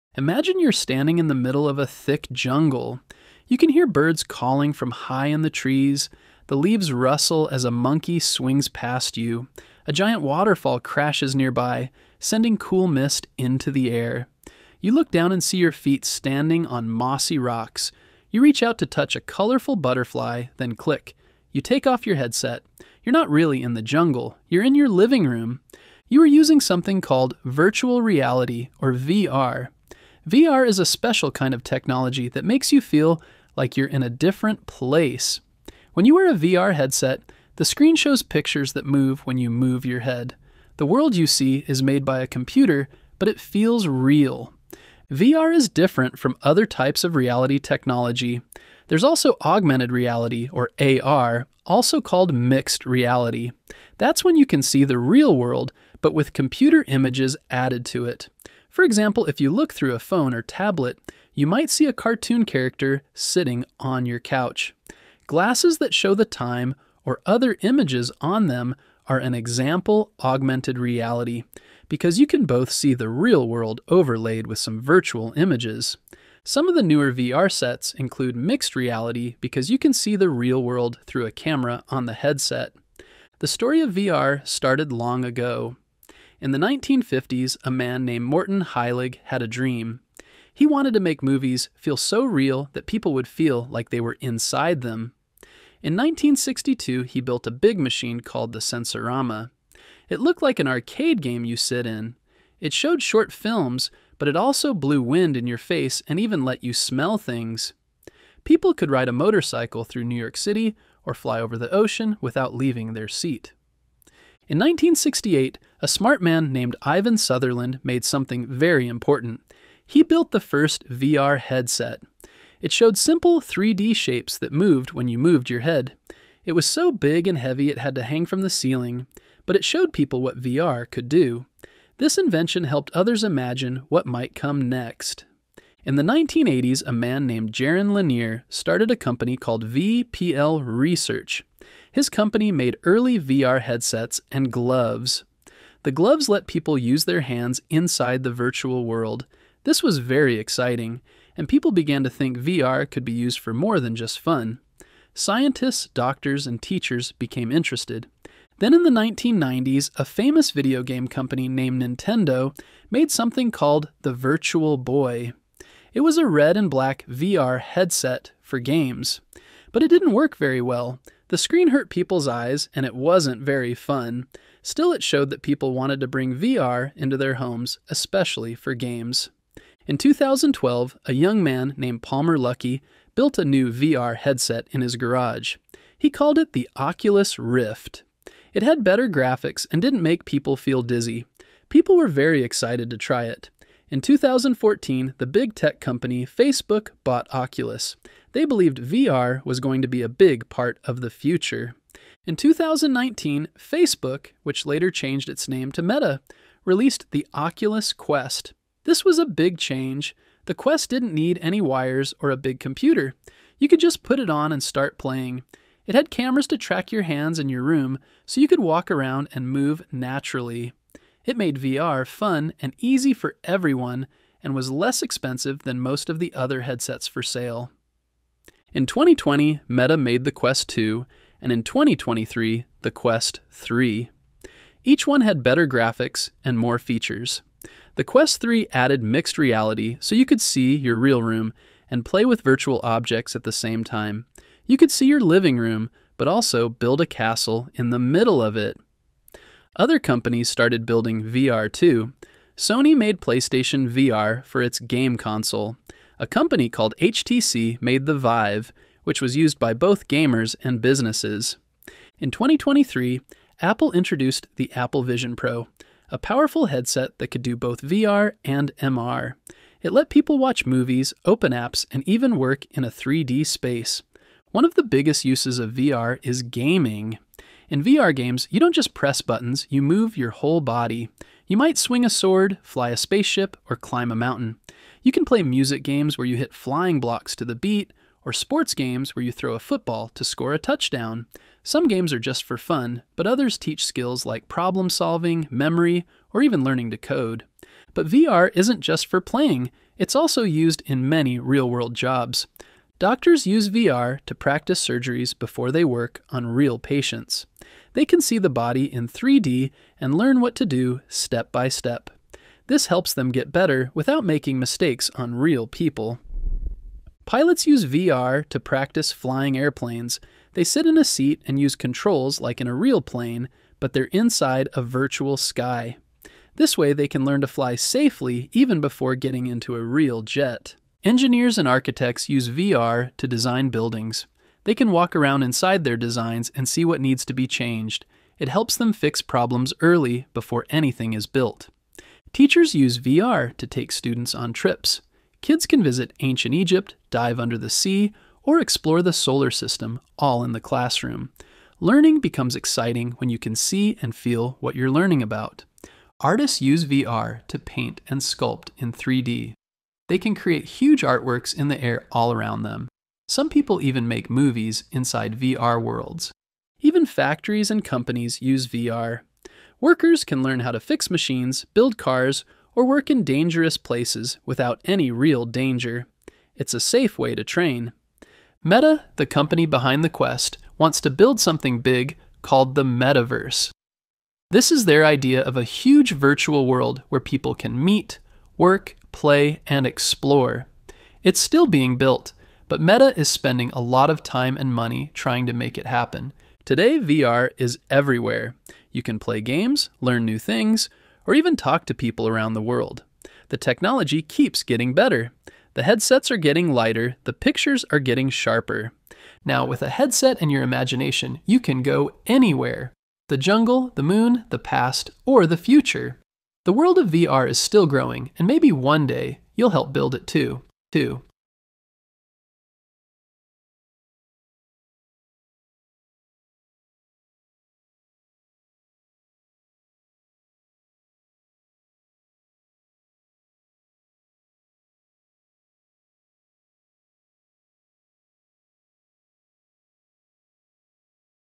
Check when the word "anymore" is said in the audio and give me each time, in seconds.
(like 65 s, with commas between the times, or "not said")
not said.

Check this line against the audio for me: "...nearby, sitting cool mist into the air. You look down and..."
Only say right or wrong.
wrong.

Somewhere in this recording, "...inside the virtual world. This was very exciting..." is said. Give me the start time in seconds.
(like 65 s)
147 s.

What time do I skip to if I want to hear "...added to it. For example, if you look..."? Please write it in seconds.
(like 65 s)
57 s.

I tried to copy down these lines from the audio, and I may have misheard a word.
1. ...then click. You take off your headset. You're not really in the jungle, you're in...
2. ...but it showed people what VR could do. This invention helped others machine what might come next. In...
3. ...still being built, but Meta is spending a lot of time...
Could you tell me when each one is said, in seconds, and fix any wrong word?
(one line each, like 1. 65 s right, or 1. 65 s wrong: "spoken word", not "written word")
1. 20 s right
2. 129 s wrong: "imagine", not "machine"
3. 391 s right.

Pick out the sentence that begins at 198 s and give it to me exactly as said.
They believed VR was going to be a big part of the future.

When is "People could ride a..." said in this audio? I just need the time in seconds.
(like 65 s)
108 s.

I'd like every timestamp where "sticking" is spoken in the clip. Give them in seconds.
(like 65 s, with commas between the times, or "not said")
not said.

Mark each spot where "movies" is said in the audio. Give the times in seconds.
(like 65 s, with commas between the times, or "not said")
91 s, 270 s, 364 s.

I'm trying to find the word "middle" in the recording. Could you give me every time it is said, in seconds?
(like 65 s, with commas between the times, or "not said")
1 s, 247 s.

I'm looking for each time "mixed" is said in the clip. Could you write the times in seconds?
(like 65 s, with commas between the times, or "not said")
52 s, 78 s, 239 s.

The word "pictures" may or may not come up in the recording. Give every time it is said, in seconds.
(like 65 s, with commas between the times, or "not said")
38 s, 407 s.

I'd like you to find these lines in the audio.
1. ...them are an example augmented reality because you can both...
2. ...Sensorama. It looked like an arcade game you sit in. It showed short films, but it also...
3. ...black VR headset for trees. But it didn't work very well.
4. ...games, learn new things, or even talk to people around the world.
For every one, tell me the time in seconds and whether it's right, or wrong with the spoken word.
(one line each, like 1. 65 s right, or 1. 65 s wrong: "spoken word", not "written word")
1. 68 s right
2. 98 s right
3. 166 s wrong: "games", not "trees"
4. 399 s right.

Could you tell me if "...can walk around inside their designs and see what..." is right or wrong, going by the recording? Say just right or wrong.
right.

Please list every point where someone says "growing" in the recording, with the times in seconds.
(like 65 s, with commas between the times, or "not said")
417 s.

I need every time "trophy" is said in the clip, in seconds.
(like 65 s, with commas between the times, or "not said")
not said.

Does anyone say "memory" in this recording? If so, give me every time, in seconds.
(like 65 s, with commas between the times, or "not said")
295 s.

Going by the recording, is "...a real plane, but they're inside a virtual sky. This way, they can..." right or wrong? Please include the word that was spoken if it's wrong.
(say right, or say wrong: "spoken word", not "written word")
right.